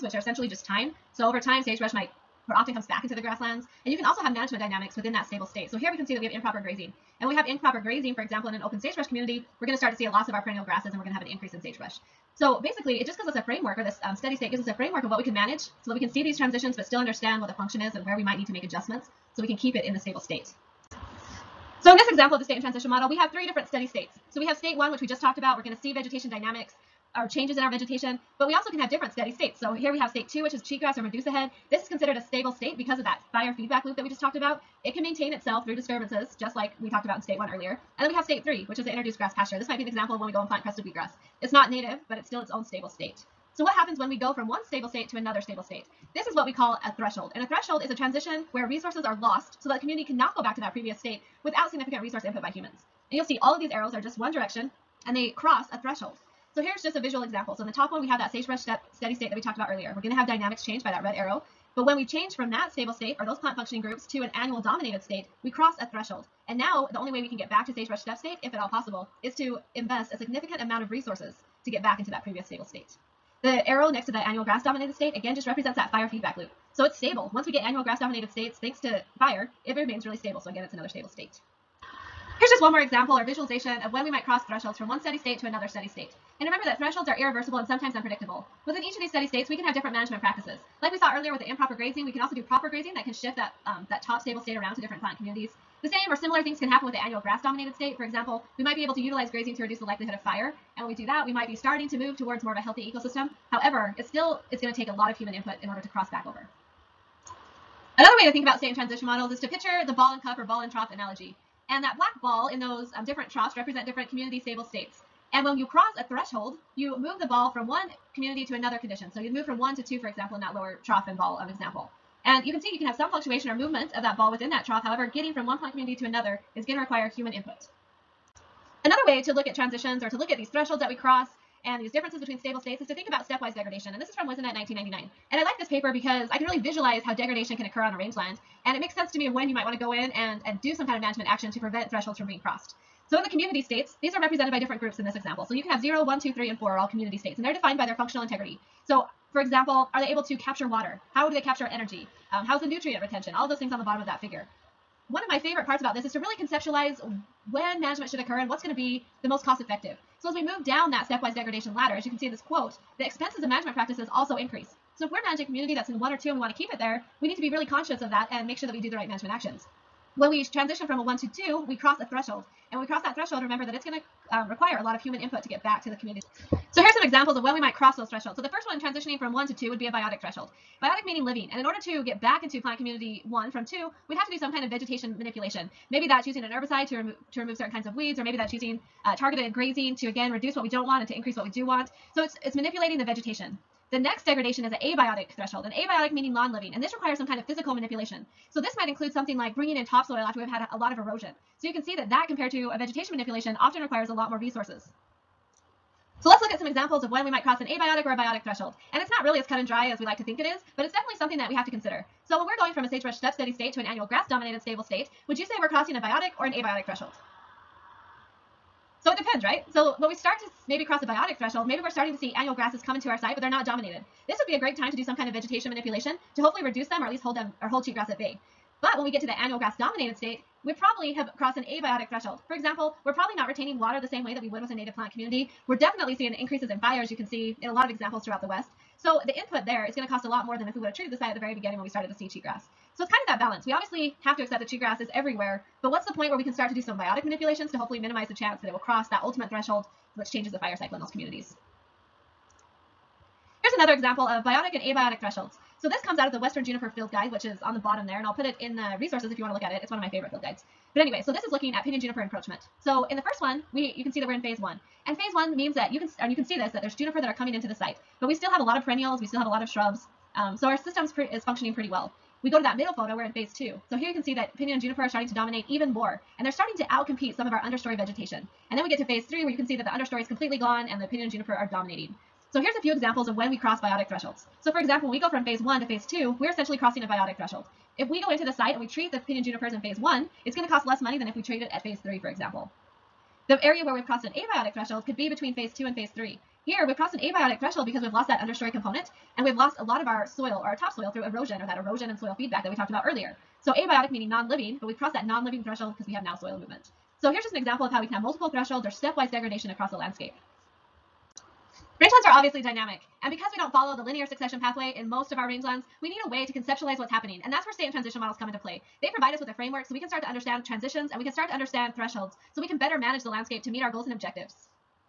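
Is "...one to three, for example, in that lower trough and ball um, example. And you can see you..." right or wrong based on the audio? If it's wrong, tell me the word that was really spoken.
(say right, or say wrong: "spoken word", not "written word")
wrong: "two", not "three".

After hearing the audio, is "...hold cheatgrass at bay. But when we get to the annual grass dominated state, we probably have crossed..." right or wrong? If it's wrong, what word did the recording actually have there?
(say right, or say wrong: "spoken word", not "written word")
right.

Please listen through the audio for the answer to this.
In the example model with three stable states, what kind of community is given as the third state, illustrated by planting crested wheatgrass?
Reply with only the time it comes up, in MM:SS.
00:38.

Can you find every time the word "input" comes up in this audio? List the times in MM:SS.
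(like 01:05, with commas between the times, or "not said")
00:52, 01:45, 02:07, 02:55, 03:59.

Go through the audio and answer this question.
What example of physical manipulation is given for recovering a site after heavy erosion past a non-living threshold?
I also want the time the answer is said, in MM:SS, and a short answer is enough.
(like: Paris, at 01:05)
bringing in topsoil, at 03:19.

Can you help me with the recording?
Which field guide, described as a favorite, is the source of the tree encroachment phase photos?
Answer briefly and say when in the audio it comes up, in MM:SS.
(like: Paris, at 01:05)
Western Juniper Field Guide, at 04:16.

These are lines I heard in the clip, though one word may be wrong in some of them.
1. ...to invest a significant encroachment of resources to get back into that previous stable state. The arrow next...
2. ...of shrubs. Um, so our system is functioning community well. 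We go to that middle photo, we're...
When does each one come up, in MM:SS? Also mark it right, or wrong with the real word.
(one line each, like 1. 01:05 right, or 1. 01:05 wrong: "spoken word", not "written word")
1. 01:09 wrong: "amount", not "encroachment"
2. 04:29 wrong: "pretty", not "community".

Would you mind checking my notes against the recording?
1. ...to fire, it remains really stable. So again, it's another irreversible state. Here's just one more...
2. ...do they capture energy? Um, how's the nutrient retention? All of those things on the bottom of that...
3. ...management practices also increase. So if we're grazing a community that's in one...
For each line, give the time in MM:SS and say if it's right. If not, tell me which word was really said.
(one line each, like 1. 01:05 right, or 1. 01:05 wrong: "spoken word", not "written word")
1. 01:18 wrong: "stable", not "irreversible"
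2. 02:31 right
3. 02:43 wrong: "managing", not "grazing".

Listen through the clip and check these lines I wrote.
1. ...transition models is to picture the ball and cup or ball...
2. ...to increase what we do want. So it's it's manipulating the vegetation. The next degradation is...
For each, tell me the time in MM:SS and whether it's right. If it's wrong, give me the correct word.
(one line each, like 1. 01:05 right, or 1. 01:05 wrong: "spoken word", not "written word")
1. 01:48 right
2. 03:11 right.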